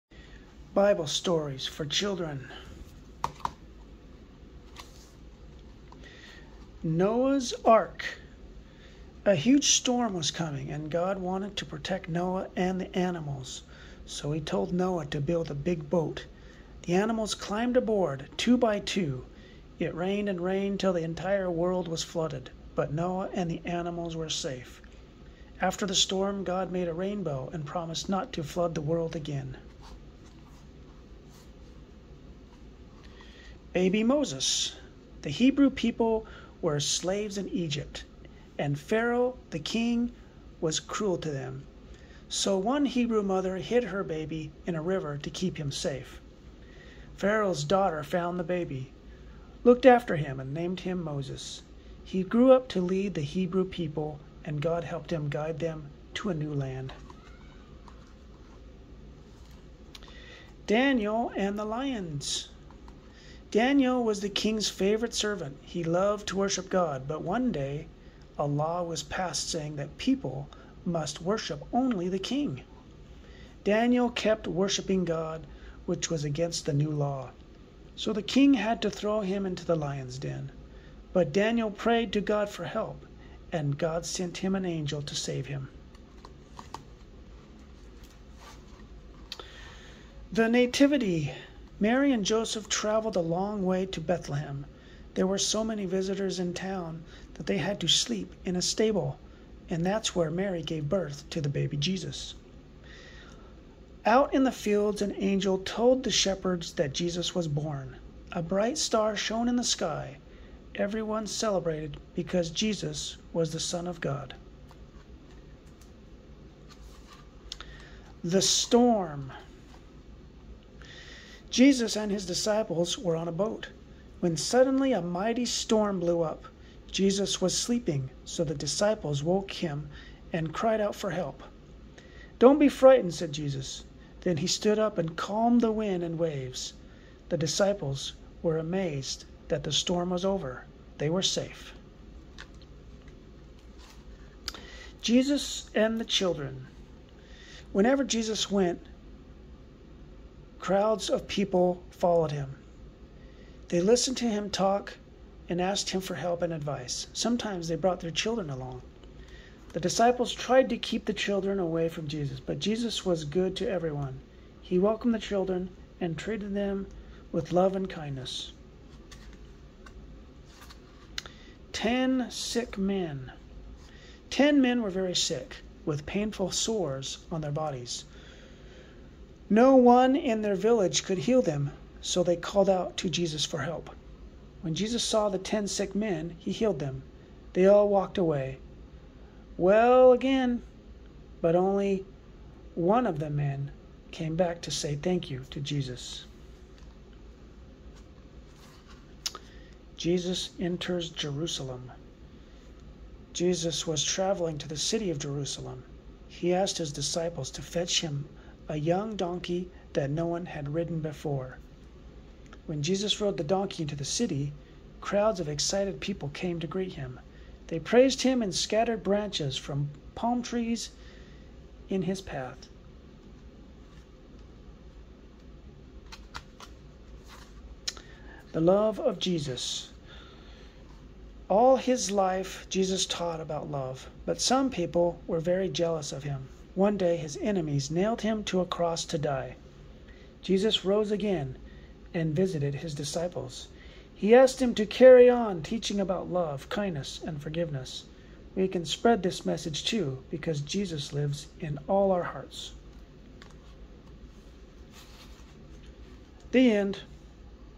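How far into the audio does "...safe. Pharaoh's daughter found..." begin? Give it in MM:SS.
00:45.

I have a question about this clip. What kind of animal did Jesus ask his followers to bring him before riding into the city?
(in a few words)
A young donkey.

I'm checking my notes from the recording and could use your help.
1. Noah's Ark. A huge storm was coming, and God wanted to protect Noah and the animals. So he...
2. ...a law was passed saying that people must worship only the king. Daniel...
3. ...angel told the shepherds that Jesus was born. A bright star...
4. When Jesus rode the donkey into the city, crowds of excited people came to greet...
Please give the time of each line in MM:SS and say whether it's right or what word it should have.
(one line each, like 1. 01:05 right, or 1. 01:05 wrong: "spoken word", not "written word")
1. 00:06 right
2. 01:08 right
3. 01:45 right
4. 03:32 right.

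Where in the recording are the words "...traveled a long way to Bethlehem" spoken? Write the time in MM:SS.
01:32.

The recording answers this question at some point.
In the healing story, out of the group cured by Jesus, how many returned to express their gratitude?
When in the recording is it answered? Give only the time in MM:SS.
03:11.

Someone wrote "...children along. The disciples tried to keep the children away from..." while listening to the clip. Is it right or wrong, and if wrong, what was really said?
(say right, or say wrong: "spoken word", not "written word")
right.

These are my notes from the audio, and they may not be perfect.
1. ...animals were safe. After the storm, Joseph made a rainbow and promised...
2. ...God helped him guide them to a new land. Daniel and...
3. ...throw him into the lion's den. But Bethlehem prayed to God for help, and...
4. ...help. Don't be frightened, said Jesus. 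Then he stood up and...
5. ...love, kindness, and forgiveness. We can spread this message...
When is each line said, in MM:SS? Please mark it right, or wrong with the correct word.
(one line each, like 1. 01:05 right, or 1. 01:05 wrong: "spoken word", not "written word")
1. 00:23 wrong: "God", not "Joseph"
2. 00:54 right
3. 01:18 wrong: "Daniel", not "Bethlehem"
4. 02:11 right
5. 04:06 right.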